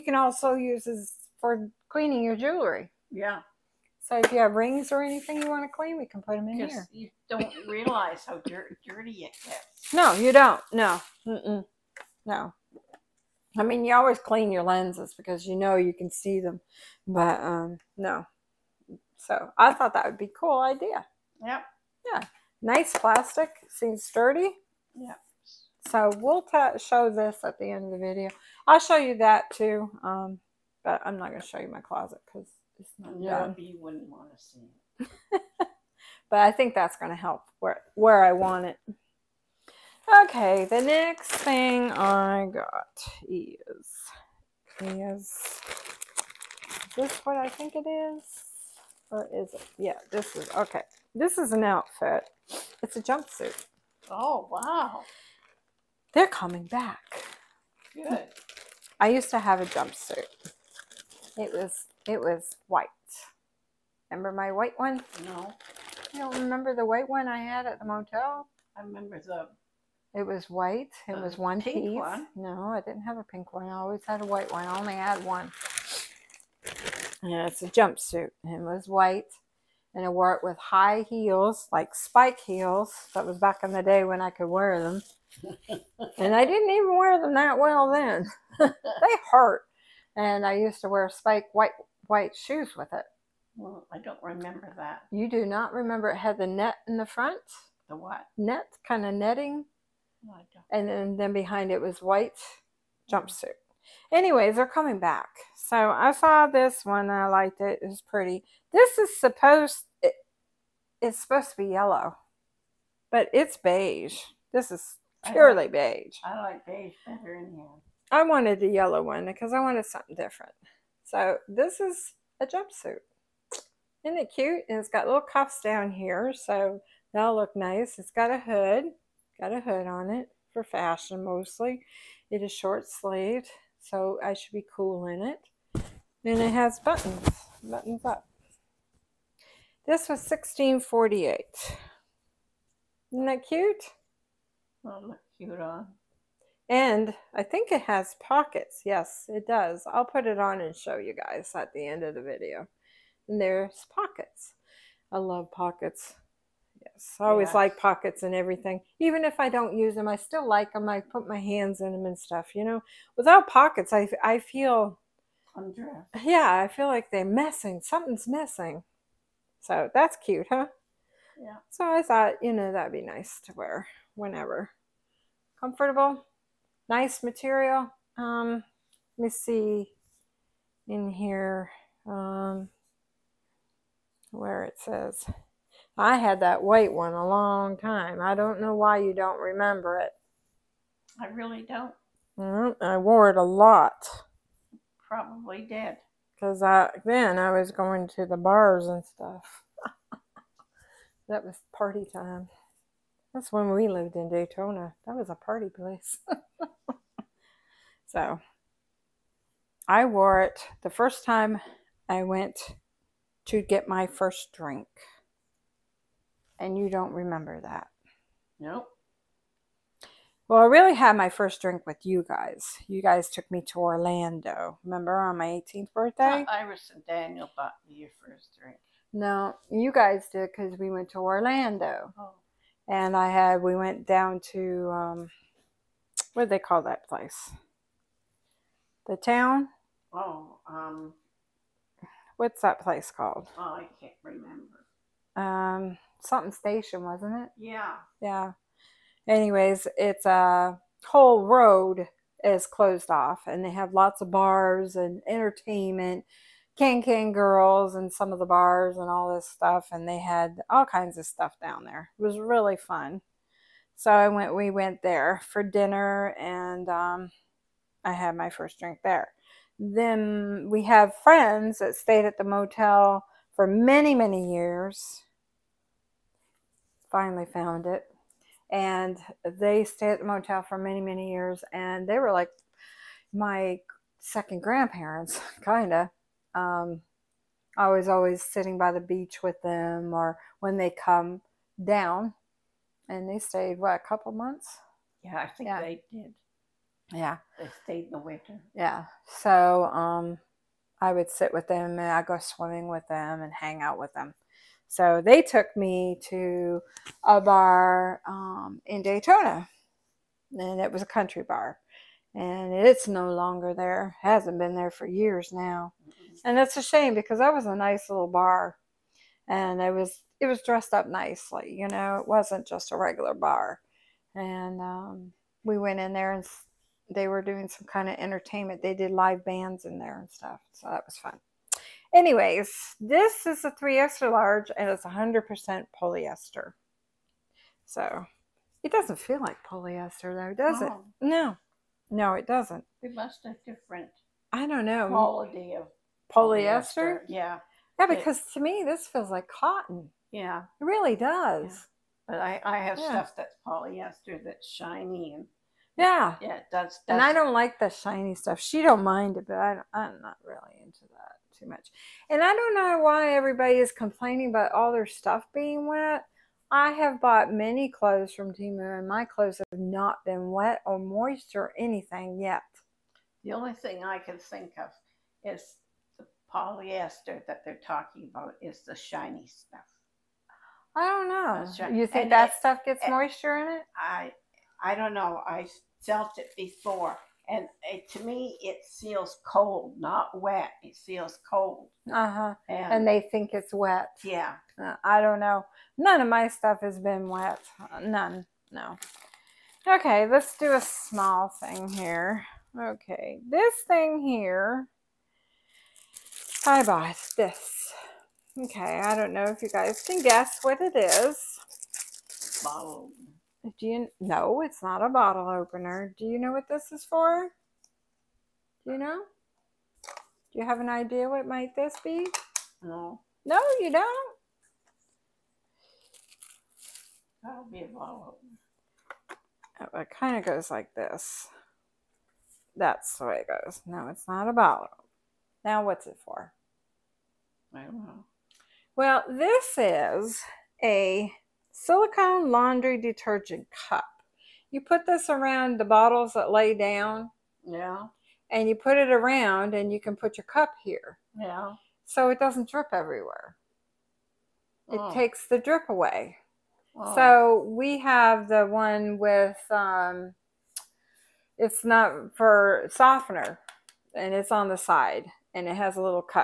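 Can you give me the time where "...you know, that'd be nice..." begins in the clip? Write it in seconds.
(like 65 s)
172 s.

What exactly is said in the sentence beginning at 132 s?
It is short sleeved, so I should be cool in it.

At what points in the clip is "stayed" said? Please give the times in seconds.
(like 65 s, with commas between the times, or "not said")
271 s, 279 s, 293 s, 297 s.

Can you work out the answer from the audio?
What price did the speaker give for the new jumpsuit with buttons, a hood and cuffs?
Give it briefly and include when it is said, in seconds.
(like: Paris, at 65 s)
16.48, at 140 s.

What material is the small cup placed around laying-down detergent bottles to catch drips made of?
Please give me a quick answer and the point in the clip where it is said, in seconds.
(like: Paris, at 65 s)
Silicone, at 441 s.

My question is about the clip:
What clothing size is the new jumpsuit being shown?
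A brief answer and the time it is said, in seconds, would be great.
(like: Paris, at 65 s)
3XL, at 333 s.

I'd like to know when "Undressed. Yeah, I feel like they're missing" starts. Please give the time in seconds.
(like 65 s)
165 s.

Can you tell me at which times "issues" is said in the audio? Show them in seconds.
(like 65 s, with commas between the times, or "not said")
not said.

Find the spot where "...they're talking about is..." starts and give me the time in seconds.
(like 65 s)
377 s.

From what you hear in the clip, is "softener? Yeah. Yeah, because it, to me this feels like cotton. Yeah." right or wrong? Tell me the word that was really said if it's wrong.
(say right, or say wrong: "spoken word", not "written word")
wrong: "polyester", not "softener".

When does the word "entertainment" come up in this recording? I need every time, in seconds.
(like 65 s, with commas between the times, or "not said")
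255 s, 328 s.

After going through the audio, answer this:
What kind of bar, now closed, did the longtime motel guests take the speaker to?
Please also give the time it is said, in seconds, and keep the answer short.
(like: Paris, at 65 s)
A country bar, at 311 s.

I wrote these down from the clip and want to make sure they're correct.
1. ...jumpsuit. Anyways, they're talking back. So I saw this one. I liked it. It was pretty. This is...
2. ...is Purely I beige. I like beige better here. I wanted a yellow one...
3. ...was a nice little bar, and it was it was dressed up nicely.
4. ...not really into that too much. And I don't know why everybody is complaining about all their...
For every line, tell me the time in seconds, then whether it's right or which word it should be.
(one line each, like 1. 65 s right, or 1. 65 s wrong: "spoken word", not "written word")
1. 103 s wrong: "coming", not "talking"
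2. 114 s right
3. 317 s right
4. 360 s right.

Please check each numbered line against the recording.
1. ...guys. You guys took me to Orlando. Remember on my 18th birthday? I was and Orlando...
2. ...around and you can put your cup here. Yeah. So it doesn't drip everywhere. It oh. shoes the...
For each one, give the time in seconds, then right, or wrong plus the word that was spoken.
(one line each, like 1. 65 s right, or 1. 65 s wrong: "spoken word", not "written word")
1. 222 s wrong: "Daniel", not "Orlando"
2. 449 s wrong: "takes", not "shoes".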